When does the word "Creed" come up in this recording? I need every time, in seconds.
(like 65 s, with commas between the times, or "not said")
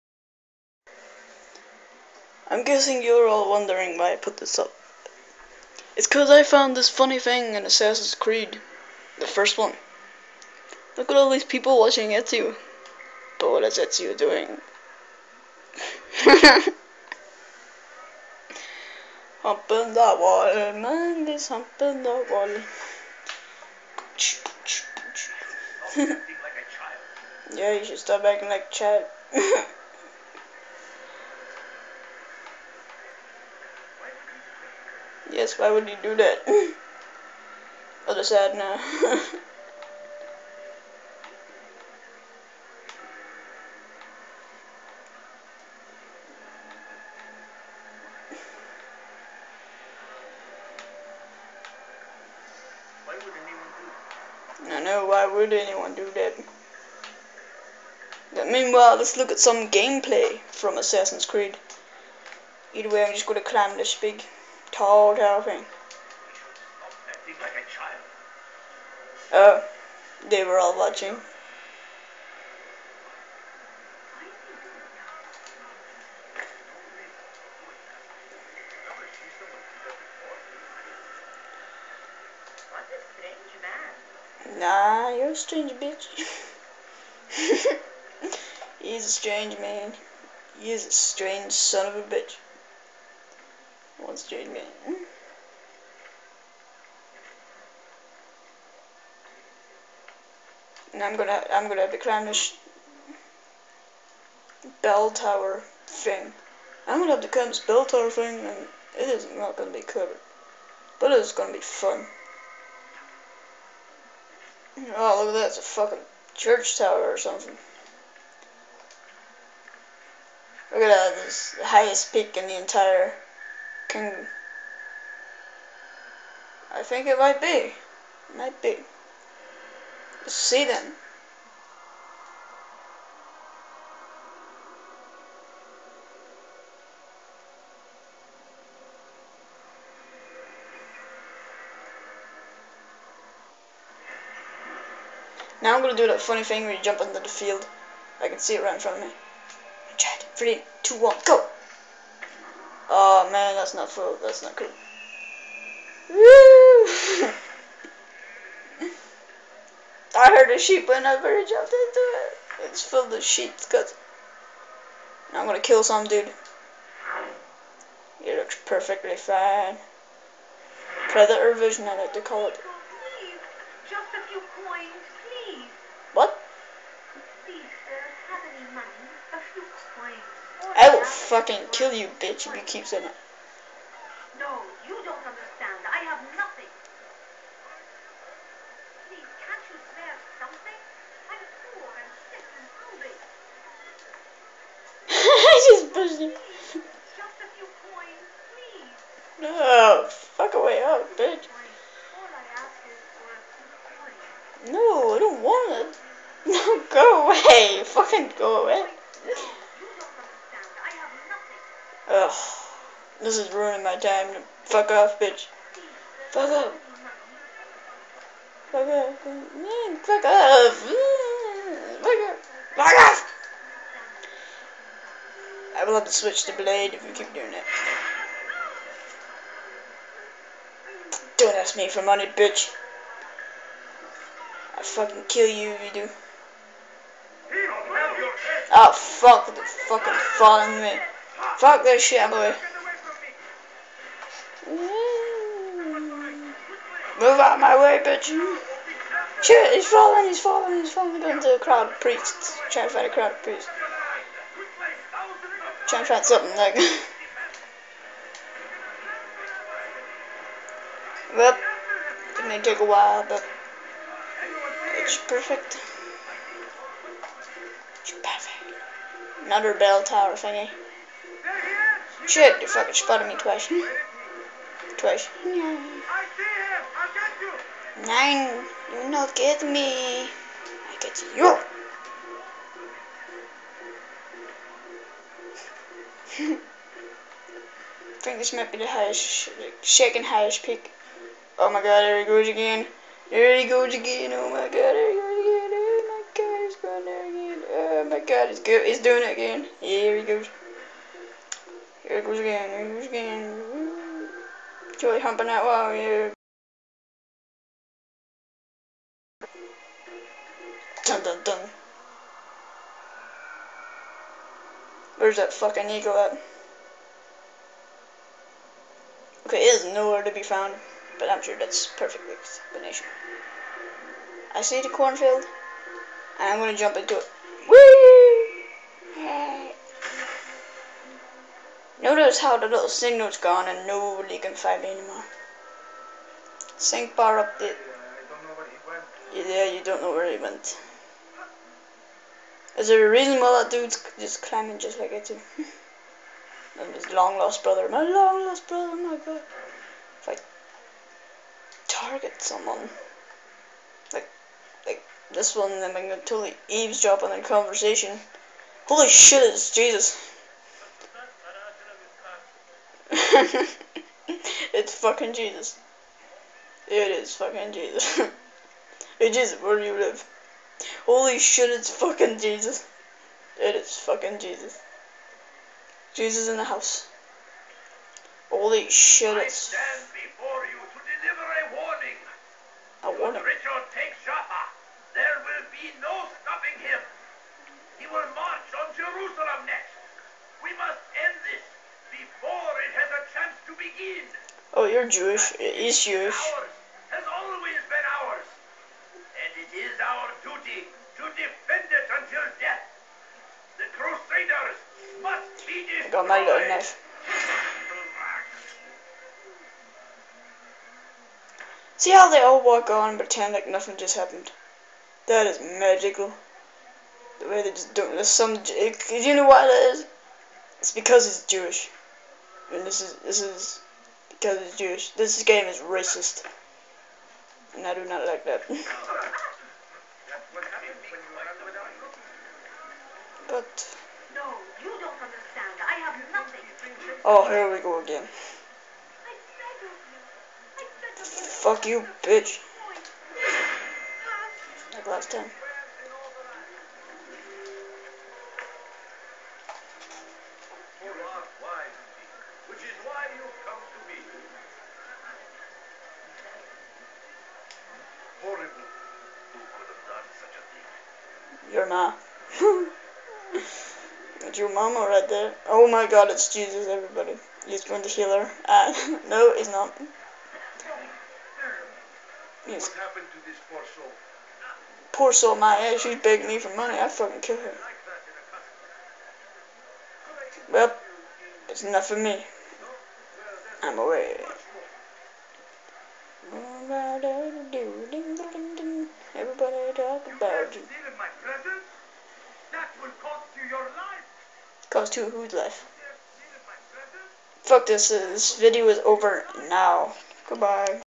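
8 s, 61 s.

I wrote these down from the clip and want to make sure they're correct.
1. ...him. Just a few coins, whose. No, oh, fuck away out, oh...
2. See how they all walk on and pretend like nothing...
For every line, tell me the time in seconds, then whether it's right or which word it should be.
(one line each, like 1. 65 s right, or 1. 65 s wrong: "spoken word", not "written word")
1. 196 s wrong: "please", not "whose"
2. 411 s right.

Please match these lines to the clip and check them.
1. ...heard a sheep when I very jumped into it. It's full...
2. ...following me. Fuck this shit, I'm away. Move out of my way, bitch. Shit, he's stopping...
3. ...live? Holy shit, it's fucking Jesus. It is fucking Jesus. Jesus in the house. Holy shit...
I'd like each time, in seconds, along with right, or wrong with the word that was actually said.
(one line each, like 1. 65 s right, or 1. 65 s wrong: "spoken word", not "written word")
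1. 160 s right
2. 240 s wrong: "falling", not "stopping"
3. 369 s right.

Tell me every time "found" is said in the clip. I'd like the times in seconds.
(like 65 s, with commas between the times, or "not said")
6 s, 320 s.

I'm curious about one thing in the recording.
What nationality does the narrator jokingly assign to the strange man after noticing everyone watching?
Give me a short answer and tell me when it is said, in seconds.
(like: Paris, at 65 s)
Australian, at 94 s.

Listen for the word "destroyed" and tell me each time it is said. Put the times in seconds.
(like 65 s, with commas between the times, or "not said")
405 s.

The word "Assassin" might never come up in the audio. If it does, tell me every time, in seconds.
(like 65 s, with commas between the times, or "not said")
7 s, 60 s.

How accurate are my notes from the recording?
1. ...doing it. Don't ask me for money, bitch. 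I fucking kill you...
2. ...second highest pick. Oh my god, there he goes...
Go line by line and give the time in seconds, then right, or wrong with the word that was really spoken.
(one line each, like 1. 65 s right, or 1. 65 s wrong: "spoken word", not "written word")
1. 227 s right
2. 289 s right.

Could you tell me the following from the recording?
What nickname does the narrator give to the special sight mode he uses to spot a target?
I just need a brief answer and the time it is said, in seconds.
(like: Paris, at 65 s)
Predator vision, at 171 s.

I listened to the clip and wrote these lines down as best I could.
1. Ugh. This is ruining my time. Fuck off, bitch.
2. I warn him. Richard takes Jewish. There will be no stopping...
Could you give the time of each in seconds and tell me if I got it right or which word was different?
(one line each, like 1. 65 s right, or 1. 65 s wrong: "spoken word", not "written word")
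1. 212 s right
2. 383 s wrong: "Joppa", not "Jewish".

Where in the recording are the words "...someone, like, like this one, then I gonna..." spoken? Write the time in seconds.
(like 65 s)
352 s.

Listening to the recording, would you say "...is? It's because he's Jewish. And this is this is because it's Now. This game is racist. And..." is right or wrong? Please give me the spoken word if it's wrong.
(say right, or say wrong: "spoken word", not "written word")
wrong: "Jewish", not "Now".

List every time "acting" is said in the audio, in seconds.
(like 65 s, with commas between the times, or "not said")
28 s.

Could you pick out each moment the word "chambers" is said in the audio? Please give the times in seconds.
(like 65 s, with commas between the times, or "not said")
not said.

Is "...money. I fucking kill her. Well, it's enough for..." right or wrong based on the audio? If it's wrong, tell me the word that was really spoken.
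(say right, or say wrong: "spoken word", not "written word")
right.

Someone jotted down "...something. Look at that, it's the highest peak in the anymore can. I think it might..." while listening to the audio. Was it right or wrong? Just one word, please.
wrong.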